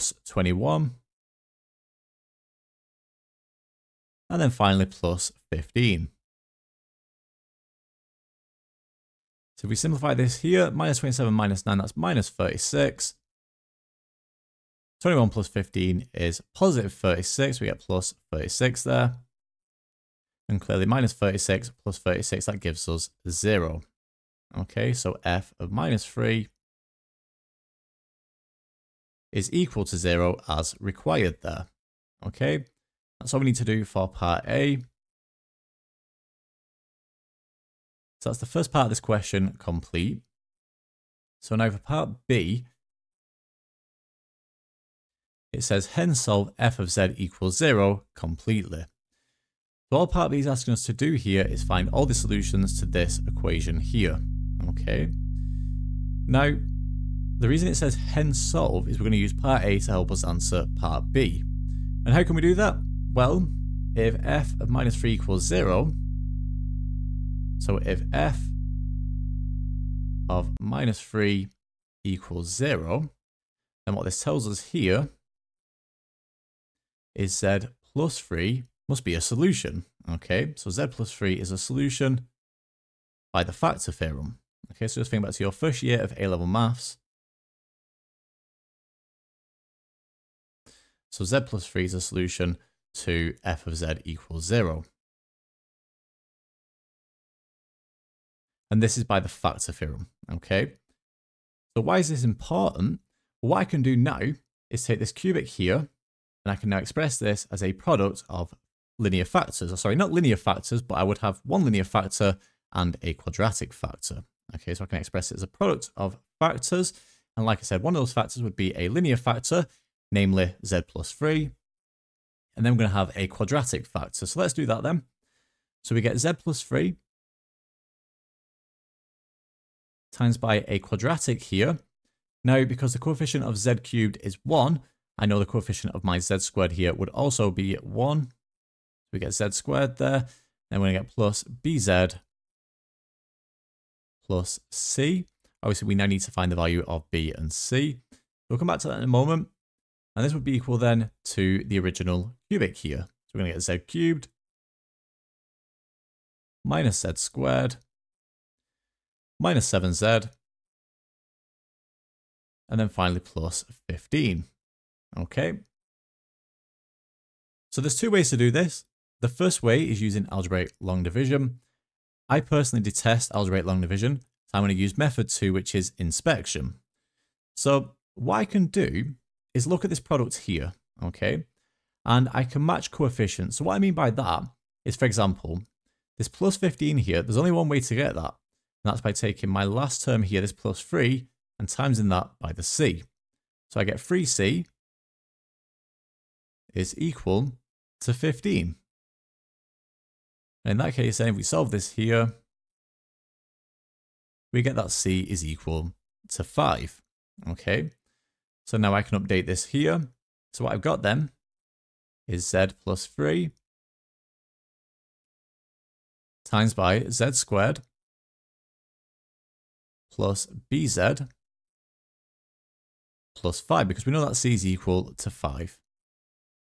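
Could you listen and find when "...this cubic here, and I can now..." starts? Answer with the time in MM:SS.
01:44.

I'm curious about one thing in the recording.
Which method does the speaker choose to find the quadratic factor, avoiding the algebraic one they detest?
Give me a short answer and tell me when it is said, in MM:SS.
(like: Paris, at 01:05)
inspection, at 02:55.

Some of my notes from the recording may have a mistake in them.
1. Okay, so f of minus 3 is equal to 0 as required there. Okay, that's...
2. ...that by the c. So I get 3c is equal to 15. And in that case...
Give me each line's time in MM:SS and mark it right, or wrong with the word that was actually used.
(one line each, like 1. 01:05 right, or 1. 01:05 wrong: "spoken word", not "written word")
1. 00:24 right
2. 03:12 right.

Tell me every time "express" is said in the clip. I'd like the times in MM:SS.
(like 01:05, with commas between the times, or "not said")
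01:46, 01:54.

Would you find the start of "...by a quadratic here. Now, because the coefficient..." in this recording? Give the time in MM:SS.
02:10.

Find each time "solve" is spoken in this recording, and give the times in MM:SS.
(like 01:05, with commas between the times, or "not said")
00:46, 00:58, 03:21.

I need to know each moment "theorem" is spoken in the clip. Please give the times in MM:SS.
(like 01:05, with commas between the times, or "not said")
01:23, 01:39.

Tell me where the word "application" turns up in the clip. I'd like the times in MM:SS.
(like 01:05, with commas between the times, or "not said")
not said.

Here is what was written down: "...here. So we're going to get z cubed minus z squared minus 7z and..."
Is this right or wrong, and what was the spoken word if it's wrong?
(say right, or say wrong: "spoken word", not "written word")
right.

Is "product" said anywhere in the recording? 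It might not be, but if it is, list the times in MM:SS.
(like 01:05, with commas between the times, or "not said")
01:47, 01:55, 02:59.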